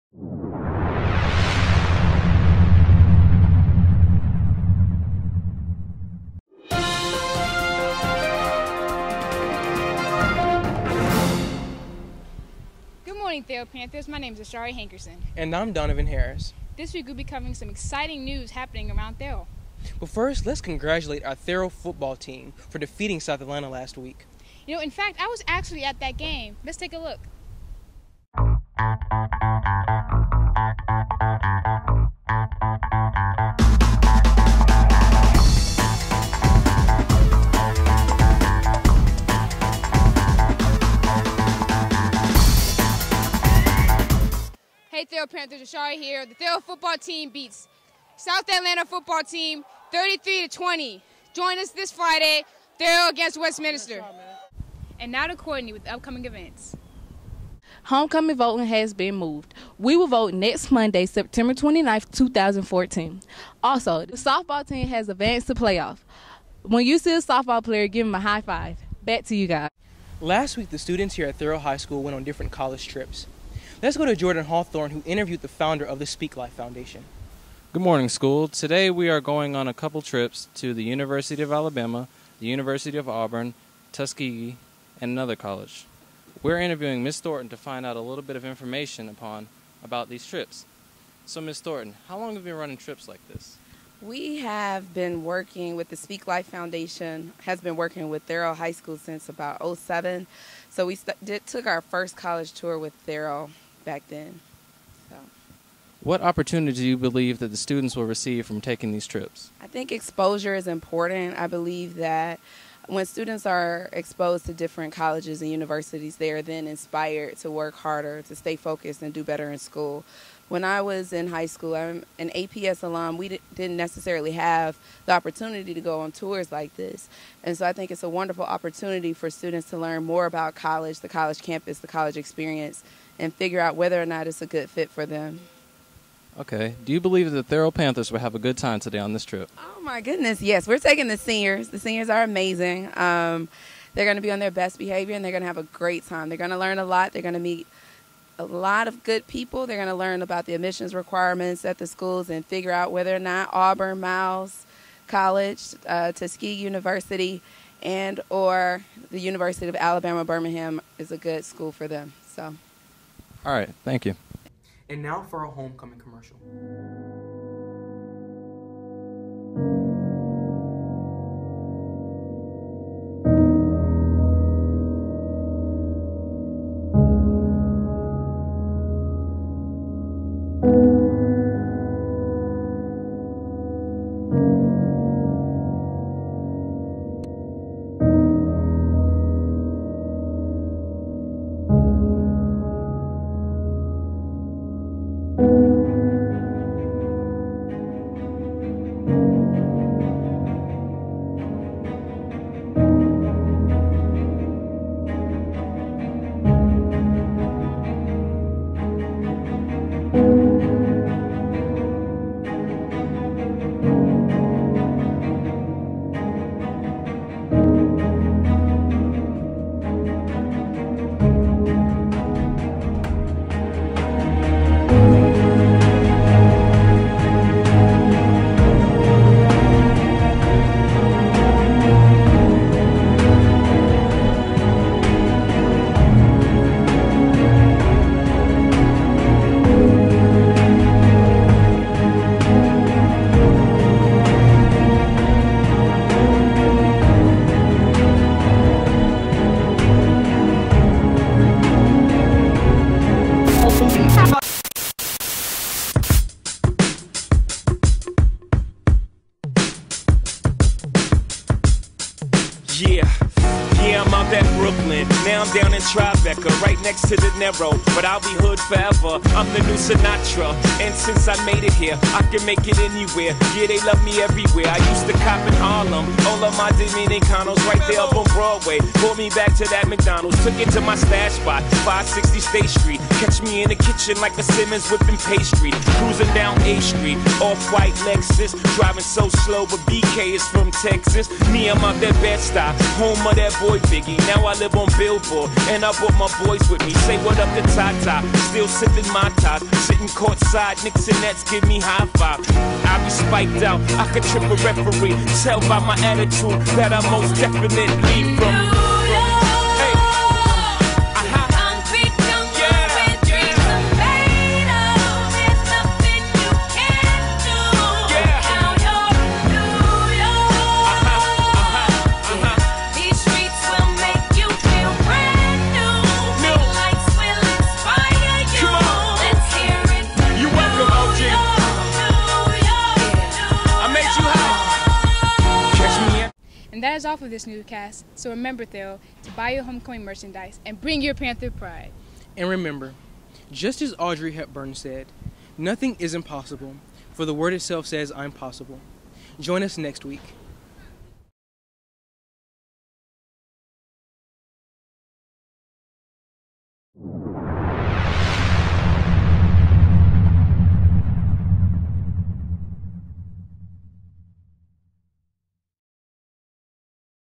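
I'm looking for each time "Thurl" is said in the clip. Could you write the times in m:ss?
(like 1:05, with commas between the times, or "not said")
1:38, 1:43.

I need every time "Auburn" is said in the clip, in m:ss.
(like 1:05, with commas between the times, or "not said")
1:23, 2:33.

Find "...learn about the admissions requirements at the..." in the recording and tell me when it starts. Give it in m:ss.
2:29.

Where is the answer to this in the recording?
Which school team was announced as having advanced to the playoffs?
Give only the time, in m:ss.
1:04.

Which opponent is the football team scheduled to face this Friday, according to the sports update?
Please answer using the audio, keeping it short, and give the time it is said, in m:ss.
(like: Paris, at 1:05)
Westminster, at 0:53.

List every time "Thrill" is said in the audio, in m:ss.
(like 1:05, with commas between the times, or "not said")
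0:46, 0:52.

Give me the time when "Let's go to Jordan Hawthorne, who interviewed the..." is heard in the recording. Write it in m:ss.
1:13.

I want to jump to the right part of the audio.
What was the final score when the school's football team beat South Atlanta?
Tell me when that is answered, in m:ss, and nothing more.
0:49.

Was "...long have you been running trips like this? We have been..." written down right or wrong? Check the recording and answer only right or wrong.
right.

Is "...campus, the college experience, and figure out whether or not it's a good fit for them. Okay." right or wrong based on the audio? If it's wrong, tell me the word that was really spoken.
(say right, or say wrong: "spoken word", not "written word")
right.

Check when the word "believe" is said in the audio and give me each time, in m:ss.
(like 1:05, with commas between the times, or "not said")
1:46, 1:51, 2:16.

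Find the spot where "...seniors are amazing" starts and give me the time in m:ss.
2:21.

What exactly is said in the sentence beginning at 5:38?
So remember, Theo, to buy your homecoming merchandise and bring your Panther pride.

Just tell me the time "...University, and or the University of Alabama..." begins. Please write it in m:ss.
2:36.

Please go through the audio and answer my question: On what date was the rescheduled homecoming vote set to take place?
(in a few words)
September 29th, 2014.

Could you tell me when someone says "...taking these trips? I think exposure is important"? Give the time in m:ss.
1:48.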